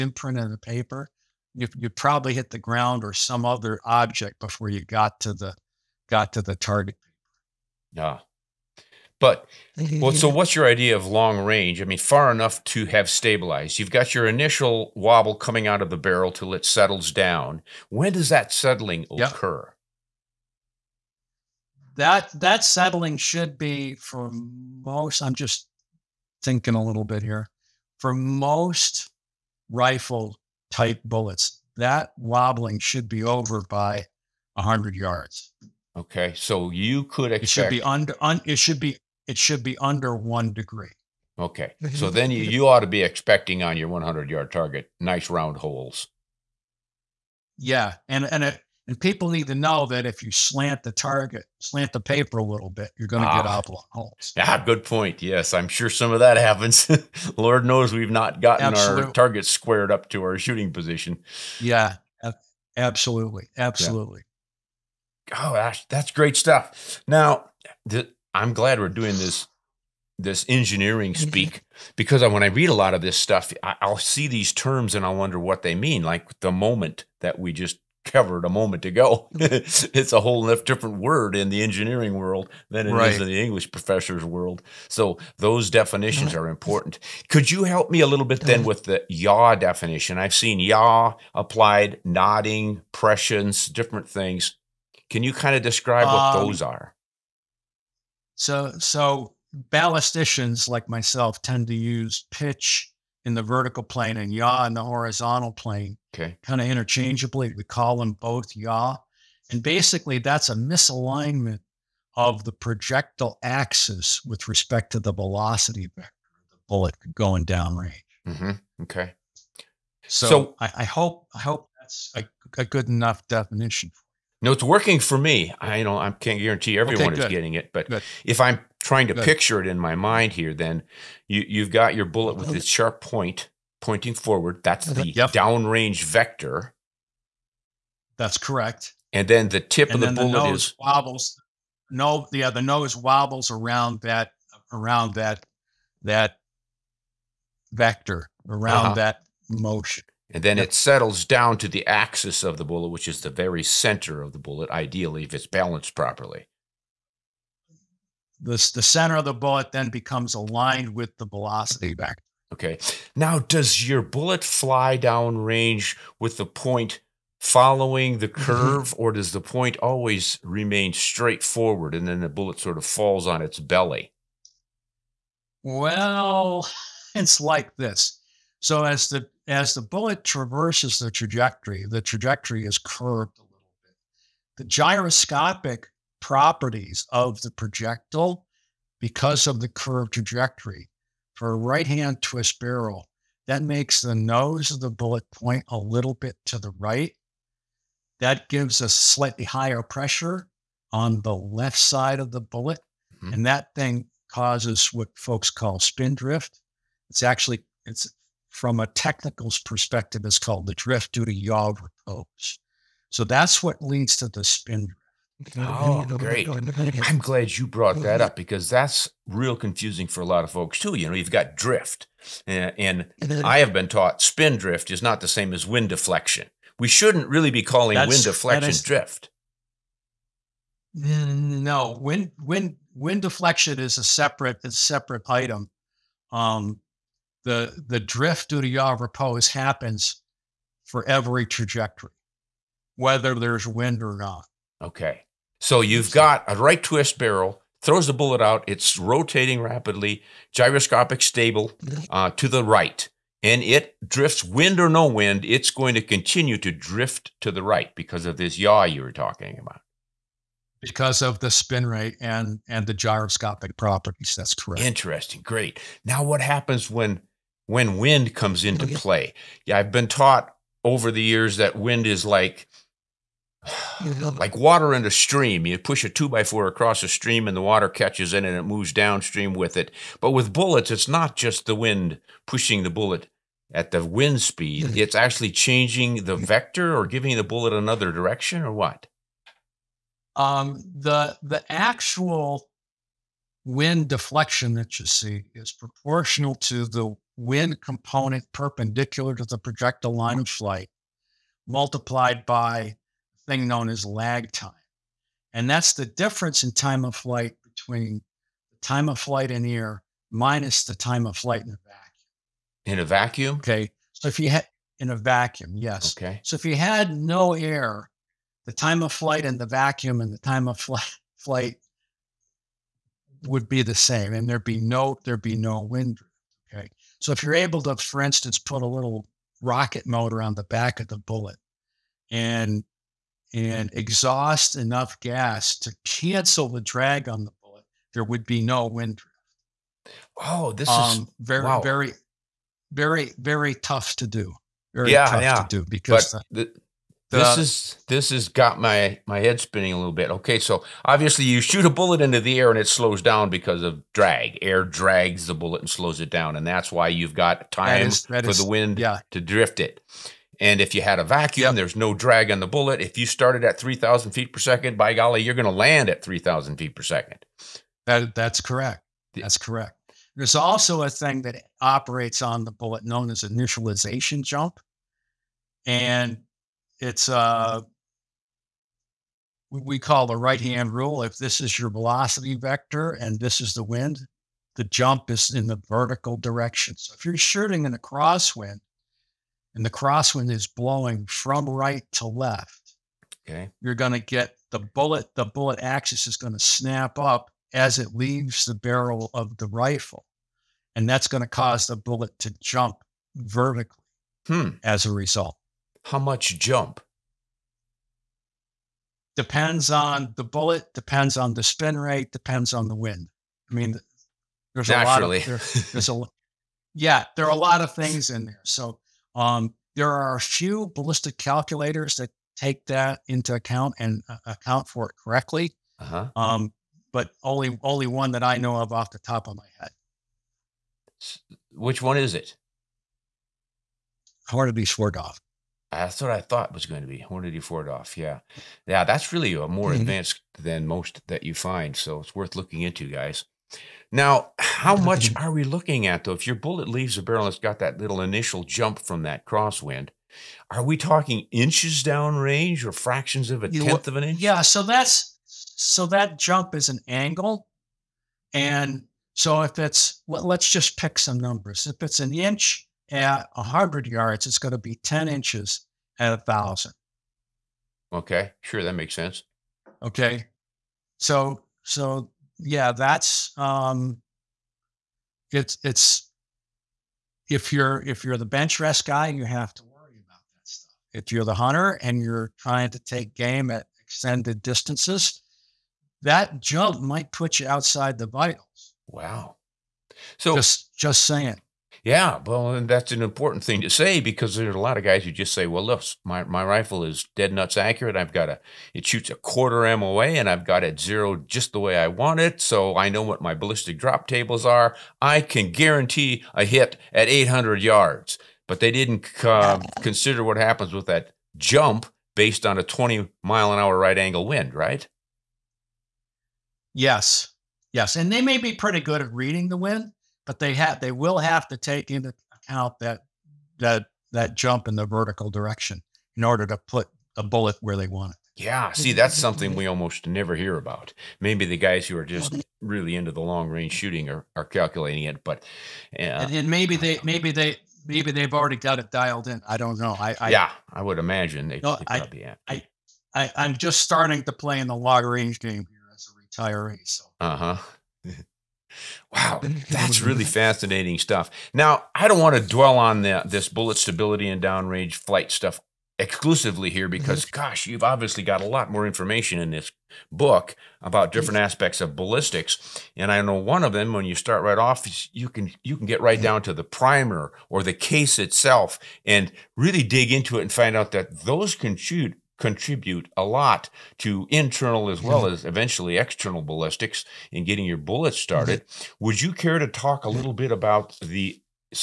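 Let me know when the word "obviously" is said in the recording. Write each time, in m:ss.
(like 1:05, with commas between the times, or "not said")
5:51, 9:18.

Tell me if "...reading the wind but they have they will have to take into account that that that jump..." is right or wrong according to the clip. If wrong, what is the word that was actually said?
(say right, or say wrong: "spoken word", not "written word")
right.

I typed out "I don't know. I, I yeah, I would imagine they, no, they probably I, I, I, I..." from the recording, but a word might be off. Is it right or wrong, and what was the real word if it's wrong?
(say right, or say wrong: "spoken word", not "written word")
right.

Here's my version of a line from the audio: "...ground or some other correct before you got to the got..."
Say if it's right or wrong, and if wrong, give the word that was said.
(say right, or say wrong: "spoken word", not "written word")
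wrong: "object", not "correct".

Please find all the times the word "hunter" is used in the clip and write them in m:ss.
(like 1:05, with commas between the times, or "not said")
8:01.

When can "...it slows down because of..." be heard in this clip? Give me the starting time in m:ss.
5:52.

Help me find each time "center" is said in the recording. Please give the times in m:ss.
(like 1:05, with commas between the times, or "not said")
2:33, 2:38.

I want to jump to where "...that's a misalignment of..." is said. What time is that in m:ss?
1:50.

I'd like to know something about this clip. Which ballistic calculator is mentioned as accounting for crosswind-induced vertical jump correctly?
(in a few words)
Hornady 4DOF.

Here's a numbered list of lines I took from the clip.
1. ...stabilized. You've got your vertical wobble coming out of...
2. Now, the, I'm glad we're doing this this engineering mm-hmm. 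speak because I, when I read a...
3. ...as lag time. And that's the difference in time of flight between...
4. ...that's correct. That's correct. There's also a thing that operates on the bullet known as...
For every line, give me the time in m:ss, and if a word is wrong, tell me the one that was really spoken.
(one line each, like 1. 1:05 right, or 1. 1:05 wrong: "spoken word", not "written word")
1. 0:13 wrong: "initial", not "vertical"
2. 1:07 right
3. 5:03 right
4. 6:08 right.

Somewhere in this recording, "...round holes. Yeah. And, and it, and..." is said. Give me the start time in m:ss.
0:45.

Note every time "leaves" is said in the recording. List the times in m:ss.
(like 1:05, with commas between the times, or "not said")
6:38, 7:26.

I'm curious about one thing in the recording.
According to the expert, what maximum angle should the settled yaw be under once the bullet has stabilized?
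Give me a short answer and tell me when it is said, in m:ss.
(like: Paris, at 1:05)
one degree, at 0:40.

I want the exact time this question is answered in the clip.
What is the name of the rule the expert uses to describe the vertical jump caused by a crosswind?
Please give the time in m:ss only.
6:20.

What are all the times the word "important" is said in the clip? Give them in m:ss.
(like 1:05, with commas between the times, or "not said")
1:26, 8:13.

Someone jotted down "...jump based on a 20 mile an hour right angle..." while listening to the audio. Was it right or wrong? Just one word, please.
right.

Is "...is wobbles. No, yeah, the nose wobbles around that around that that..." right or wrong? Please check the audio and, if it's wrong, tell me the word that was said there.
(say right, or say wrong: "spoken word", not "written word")
right.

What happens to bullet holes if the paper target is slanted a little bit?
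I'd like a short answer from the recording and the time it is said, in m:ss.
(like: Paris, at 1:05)
oblong holes, at 0:53.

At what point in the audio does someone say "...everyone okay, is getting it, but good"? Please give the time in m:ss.
2:06.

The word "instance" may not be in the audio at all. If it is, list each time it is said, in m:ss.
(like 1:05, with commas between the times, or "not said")
5:28.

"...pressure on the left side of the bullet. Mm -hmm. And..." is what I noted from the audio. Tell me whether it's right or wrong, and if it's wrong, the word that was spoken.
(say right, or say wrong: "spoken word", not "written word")
right.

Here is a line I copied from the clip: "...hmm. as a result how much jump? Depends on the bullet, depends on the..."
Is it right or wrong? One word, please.
right.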